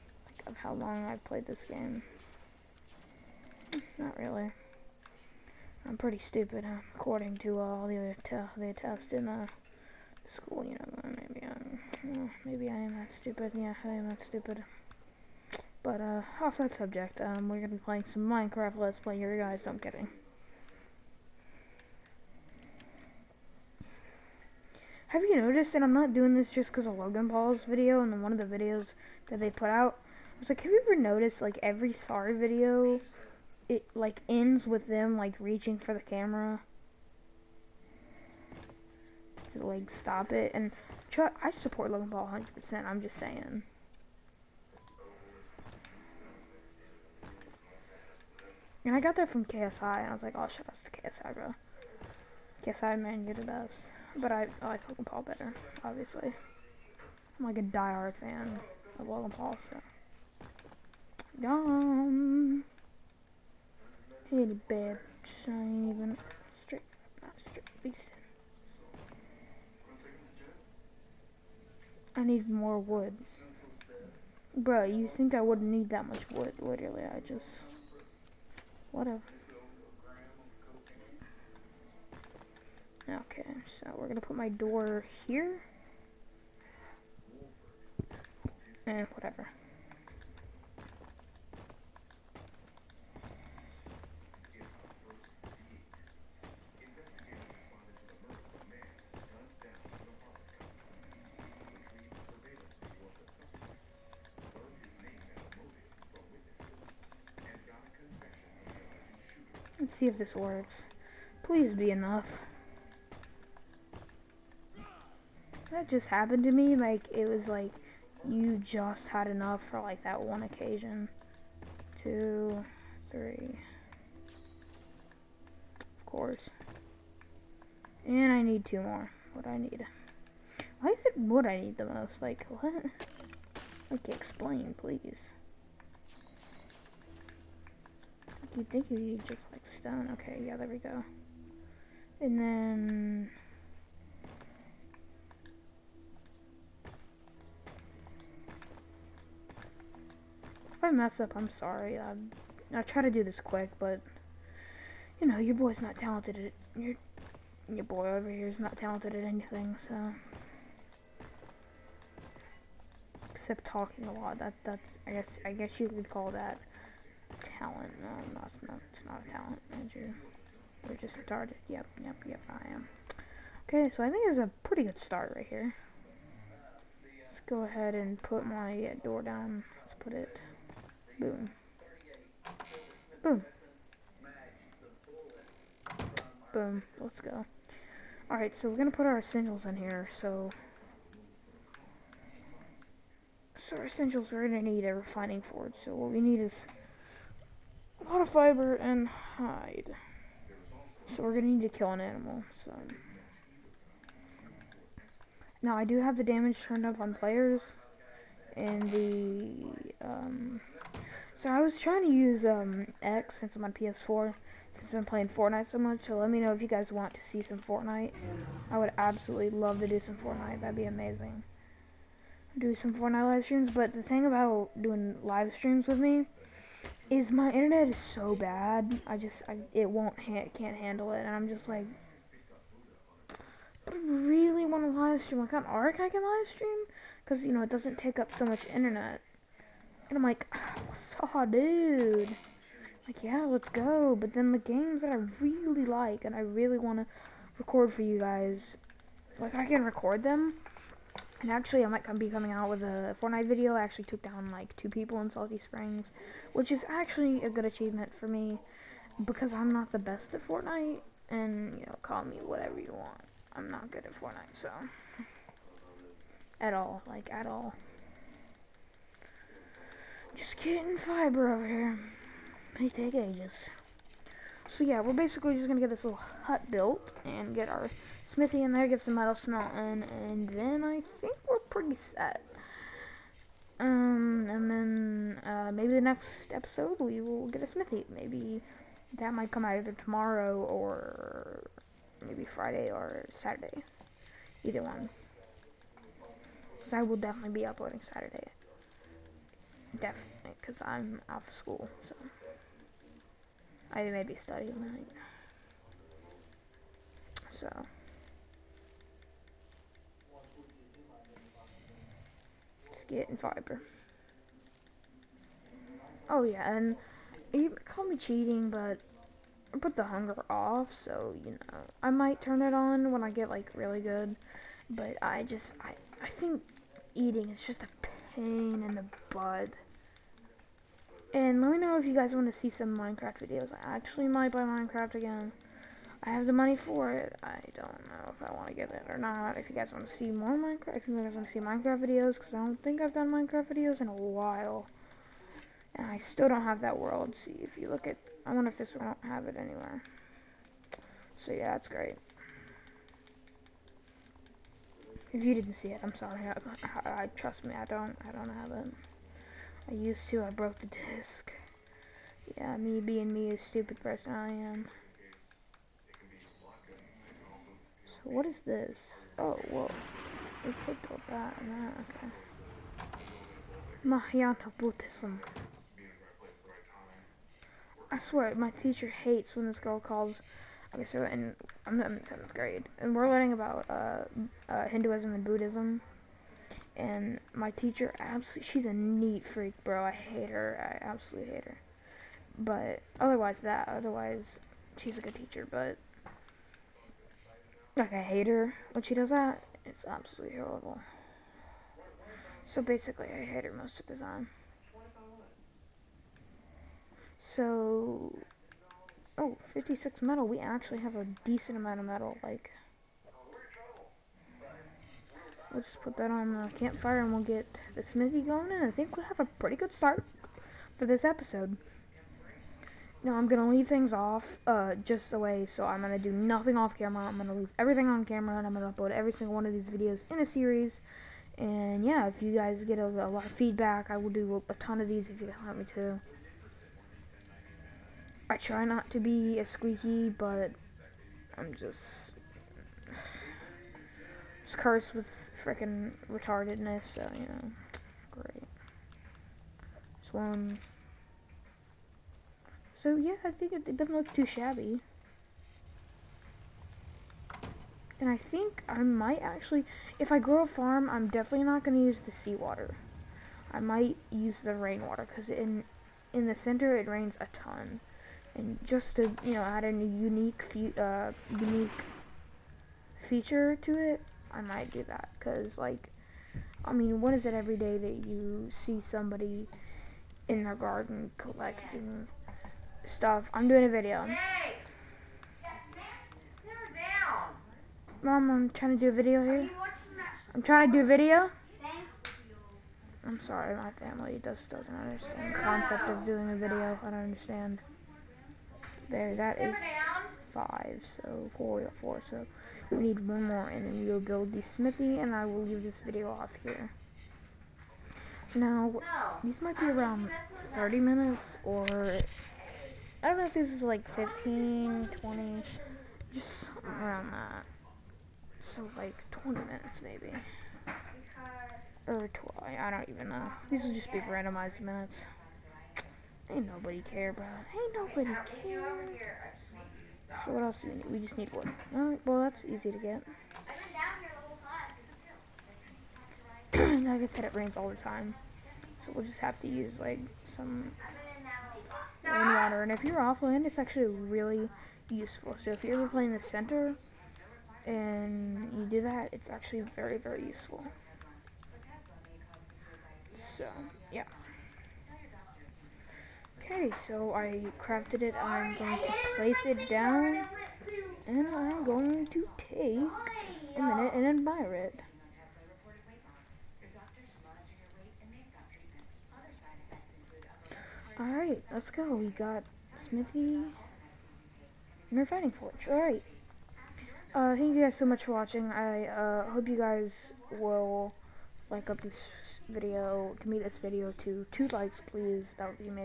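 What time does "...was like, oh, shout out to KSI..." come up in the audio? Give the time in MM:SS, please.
00:50.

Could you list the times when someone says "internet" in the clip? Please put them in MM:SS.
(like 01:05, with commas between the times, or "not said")
03:47, 03:58.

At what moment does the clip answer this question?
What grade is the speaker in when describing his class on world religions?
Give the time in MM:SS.
06:22.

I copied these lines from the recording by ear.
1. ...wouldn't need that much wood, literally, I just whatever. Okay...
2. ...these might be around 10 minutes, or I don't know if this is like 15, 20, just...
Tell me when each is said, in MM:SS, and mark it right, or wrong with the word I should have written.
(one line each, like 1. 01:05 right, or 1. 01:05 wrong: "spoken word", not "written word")
1. 01:15 right
2. 08:29 wrong: "30", not "10".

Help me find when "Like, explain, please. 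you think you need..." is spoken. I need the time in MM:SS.
02:13.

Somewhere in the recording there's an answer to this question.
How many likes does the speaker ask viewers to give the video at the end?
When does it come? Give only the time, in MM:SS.
09:44.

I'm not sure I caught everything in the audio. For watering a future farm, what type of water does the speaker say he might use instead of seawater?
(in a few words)
rainwater.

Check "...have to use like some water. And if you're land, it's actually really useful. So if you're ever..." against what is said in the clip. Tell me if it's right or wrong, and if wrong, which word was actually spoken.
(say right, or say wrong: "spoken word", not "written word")
right.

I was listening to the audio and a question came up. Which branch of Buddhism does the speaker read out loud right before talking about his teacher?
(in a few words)
Mahayana Buddhism.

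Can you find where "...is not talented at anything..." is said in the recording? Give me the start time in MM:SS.
02:38.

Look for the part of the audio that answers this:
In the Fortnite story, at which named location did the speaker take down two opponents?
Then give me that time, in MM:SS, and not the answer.
04:15.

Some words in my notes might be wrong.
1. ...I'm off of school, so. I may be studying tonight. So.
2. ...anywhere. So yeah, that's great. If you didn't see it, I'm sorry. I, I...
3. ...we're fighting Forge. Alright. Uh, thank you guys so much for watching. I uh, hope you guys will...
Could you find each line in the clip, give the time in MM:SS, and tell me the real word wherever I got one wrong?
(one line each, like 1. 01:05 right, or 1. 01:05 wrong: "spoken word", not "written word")
1. 05:00 right
2. 05:49 right
3. 09:35 right.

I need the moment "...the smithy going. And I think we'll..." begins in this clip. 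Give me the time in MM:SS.
06:57.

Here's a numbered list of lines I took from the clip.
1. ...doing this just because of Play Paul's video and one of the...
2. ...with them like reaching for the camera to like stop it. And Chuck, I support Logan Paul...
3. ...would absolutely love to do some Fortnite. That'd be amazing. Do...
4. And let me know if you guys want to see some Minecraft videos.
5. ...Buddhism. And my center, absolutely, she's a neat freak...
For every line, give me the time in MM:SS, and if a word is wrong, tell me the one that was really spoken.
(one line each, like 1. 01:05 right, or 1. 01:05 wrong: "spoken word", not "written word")
1. 00:26 wrong: "Logan", not "Play"
2. 00:34 right
3. 03:38 right
4. 05:31 right
5. 06:25 wrong: "teacher", not "center".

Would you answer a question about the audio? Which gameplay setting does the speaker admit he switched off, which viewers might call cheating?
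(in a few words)
hunger.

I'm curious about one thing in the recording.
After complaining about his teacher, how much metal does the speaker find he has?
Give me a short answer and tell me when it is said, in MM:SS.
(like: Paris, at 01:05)
56, at 06:49.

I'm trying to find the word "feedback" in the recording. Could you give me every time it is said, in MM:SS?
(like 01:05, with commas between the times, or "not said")
07:13.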